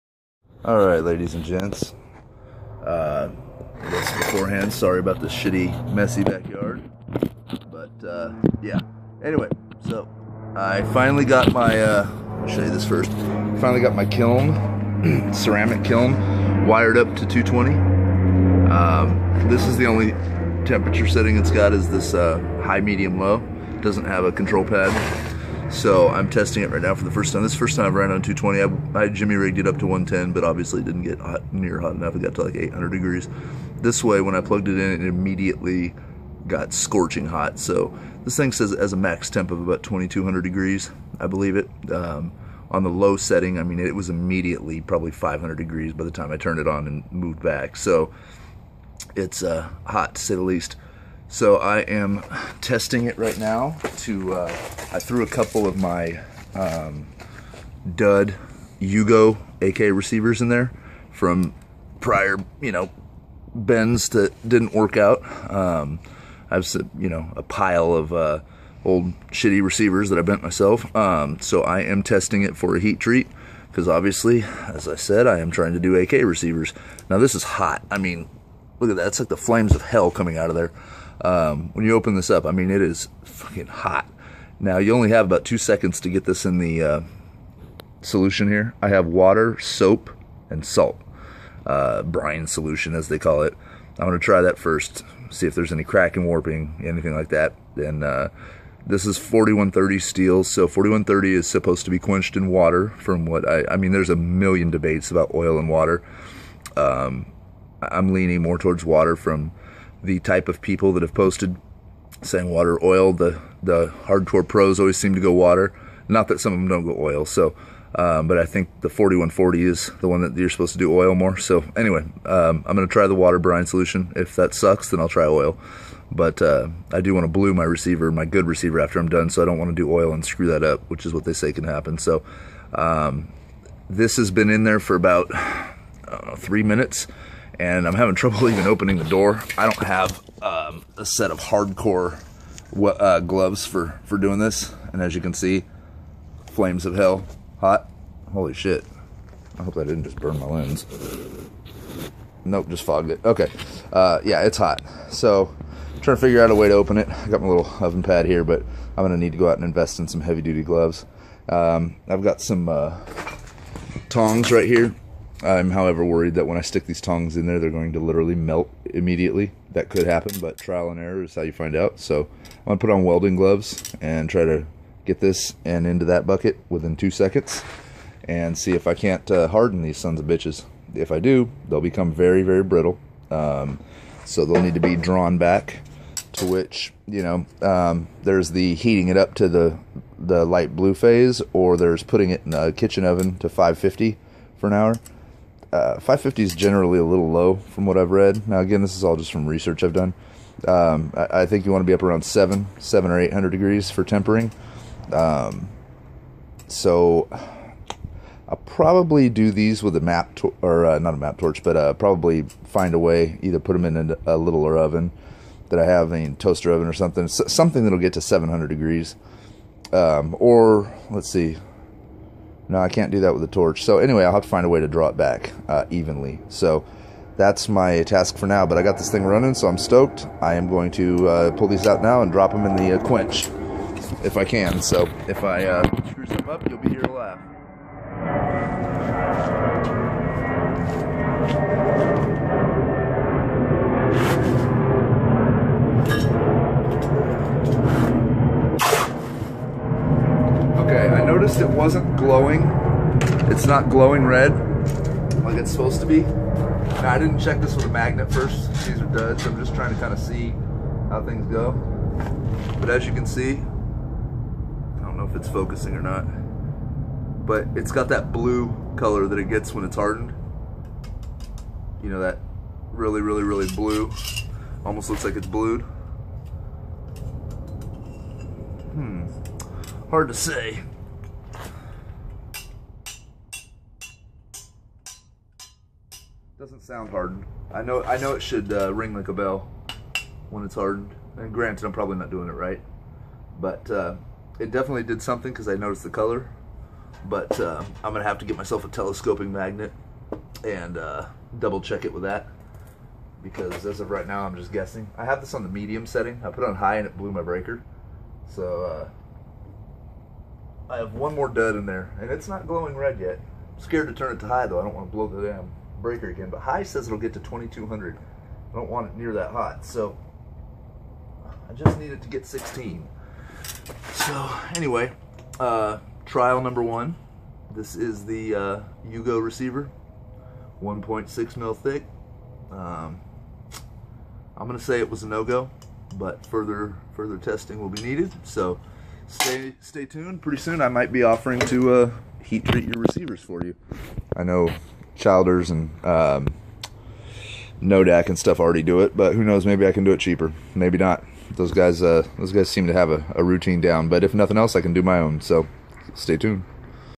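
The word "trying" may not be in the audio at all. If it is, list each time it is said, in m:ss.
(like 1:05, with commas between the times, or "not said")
1:15, 2:36, 4:19.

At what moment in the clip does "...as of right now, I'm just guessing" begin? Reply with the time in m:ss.
5:03.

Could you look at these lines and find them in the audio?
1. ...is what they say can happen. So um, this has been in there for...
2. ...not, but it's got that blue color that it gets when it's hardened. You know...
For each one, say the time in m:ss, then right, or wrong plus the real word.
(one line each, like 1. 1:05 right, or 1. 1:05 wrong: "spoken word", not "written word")
1. 2:11 right
2. 4:26 right.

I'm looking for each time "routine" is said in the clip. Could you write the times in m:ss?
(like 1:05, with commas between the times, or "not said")
5:53.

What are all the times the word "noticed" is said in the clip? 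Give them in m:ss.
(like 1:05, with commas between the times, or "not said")
4:11, 4:55.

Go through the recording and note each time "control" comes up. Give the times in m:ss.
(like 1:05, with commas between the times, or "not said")
0:24.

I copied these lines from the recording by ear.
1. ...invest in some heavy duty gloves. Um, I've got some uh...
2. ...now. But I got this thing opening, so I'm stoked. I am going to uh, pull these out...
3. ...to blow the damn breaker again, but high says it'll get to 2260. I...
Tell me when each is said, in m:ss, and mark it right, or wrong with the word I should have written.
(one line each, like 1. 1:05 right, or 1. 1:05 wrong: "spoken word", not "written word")
1. 2:39 right
2. 3:48 wrong: "running", not "opening"
3. 5:15 wrong: "2200", not "2260".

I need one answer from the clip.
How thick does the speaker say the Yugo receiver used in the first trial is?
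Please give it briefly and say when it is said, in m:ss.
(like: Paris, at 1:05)
1.6 mil, at 5:30.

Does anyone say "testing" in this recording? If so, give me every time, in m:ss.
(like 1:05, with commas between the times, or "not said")
0:26, 0:52, 1:12, 5:37.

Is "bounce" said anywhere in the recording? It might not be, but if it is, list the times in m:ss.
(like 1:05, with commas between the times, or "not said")
not said.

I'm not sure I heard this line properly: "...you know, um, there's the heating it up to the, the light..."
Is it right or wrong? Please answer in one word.
right.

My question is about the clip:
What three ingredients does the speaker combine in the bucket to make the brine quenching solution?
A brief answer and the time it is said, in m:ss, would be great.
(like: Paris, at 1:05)
water, soap, and salt, at 1:29.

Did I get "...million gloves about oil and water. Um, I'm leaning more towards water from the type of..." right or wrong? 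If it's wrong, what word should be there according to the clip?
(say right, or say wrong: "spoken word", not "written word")
wrong: "debates", not "gloves".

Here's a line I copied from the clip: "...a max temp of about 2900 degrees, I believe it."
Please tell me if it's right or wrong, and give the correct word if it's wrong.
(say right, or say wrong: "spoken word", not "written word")
wrong: "2200", not "2900".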